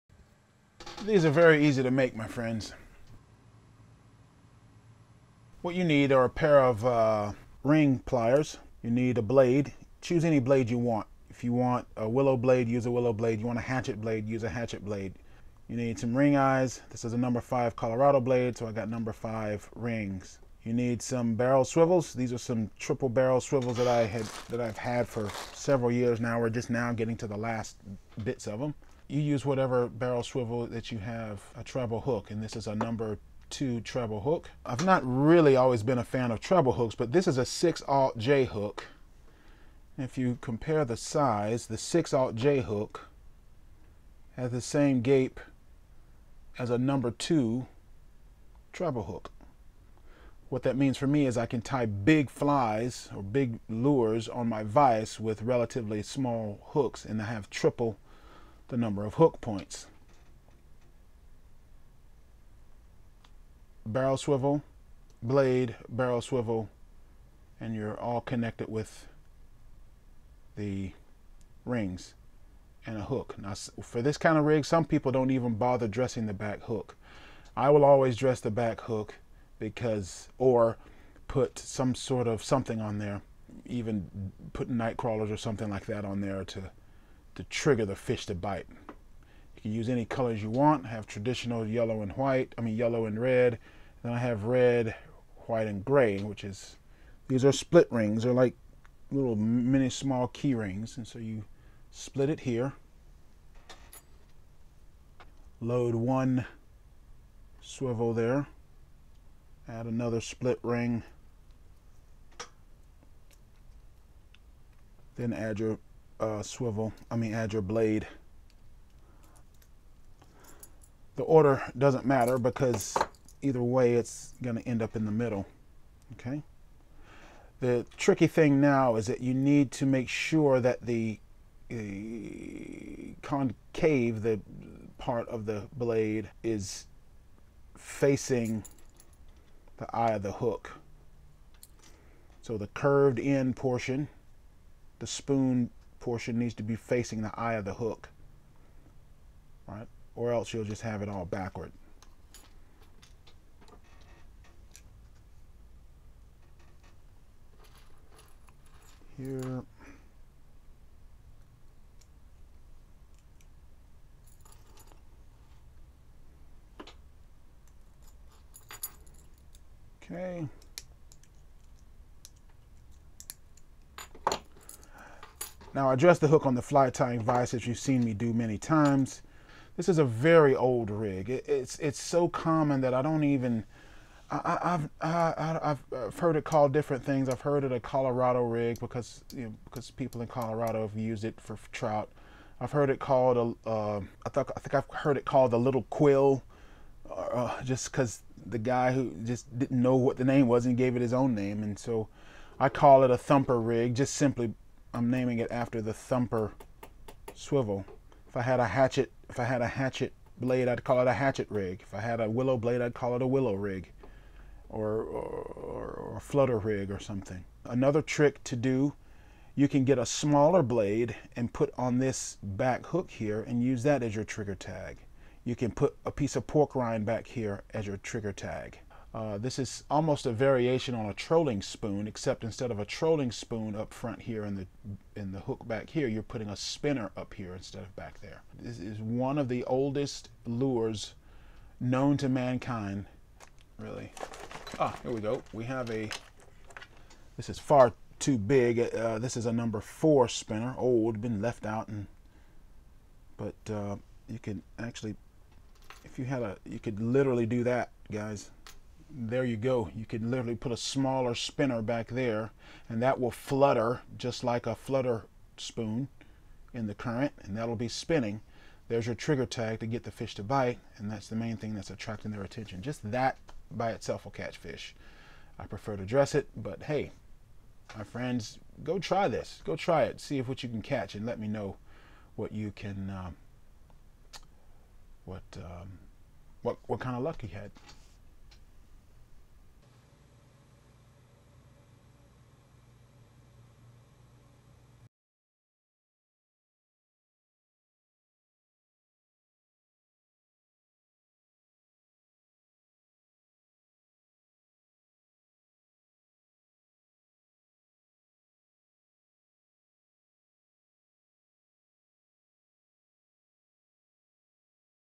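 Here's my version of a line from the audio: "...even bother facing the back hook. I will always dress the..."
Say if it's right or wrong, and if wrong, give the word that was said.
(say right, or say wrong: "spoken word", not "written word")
wrong: "dressing", not "facing".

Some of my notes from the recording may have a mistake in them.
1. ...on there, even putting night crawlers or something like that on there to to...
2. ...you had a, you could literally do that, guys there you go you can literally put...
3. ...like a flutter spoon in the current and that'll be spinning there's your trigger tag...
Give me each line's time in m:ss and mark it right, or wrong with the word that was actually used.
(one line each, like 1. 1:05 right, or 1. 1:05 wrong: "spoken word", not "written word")
1. 1:22 right
2. 4:16 right
3. 4:24 right.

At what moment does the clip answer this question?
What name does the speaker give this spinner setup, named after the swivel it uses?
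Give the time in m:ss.
3:23.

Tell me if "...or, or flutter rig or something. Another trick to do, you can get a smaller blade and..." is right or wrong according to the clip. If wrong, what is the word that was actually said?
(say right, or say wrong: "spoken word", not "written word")
right.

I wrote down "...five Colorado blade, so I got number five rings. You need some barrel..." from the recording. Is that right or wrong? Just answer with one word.
right.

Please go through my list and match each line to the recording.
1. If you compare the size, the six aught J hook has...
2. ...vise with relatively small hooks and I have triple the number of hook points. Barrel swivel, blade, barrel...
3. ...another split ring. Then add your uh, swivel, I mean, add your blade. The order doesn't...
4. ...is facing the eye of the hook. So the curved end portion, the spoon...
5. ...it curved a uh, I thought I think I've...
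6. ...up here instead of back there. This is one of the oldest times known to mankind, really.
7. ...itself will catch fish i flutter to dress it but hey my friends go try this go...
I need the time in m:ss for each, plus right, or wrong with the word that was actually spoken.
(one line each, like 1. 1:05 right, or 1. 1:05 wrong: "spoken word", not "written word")
1. 0:39 right
2. 0:54 right
3. 1:49 right
4. 2:16 right
5. 3:12 wrong: "called", not "curved"
6. 3:57 wrong: "lures", not "times"
7. 4:33 wrong: "prefer", not "flutter".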